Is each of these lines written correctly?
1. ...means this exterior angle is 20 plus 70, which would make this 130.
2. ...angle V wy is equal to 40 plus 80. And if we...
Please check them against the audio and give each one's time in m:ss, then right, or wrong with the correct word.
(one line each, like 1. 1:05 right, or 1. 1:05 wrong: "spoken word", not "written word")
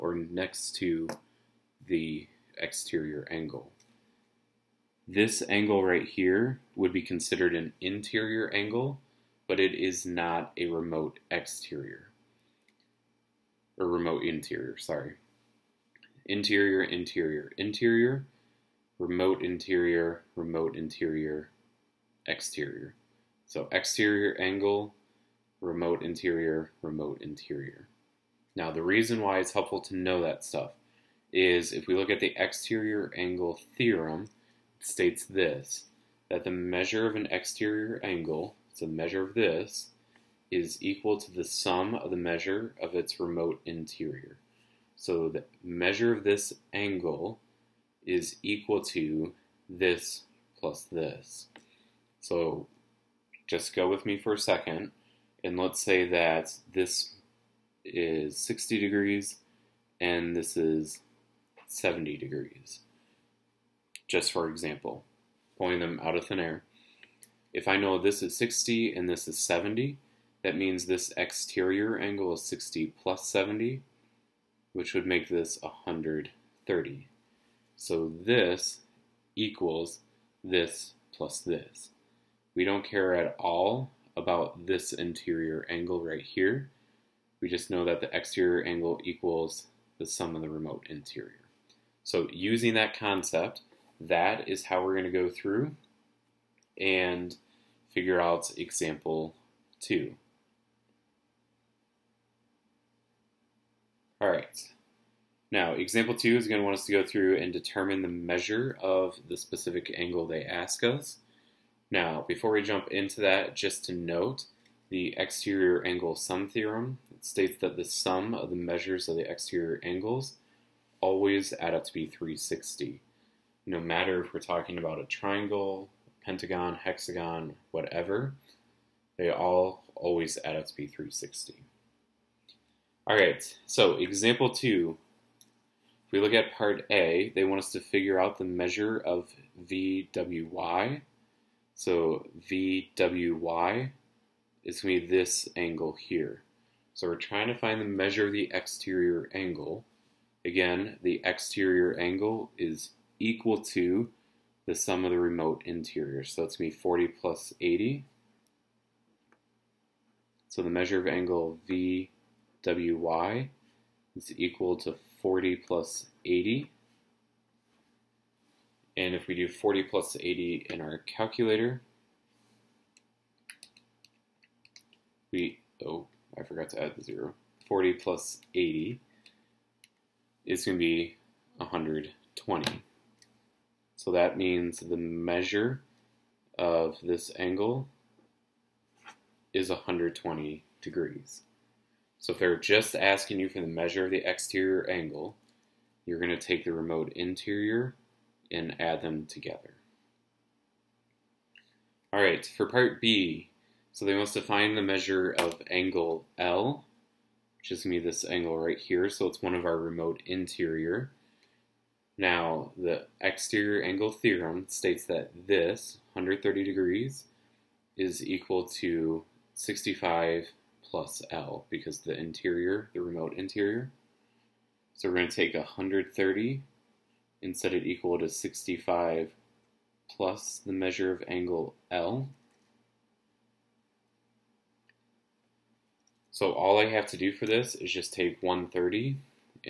1. 1:10 wrong: "60", not "20"
2. 2:41 right.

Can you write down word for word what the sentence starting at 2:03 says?
No matter if we're talking about a triangle, pentagon, hexagon, whatever, they all always add up to be 360.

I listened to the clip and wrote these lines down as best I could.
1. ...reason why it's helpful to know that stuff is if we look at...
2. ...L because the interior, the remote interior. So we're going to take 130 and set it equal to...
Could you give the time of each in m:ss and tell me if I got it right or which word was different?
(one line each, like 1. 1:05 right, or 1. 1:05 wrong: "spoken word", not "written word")
1. 0:28 right
2. 3:41 right.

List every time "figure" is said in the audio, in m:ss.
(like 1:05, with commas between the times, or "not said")
1:37, 2:17.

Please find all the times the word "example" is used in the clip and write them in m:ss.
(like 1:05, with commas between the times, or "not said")
1:04, 1:38, 1:45, 2:13.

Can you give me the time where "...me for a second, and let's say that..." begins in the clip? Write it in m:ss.
0:54.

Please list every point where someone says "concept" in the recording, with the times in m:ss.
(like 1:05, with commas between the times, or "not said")
1:32.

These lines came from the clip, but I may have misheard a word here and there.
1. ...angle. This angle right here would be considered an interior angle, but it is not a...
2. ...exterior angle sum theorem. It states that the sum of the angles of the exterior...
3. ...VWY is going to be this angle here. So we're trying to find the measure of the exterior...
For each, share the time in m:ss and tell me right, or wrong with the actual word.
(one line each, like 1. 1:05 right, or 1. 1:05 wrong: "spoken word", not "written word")
1. 0:03 right
2. 1:55 wrong: "measures", not "angles"
3. 2:22 right.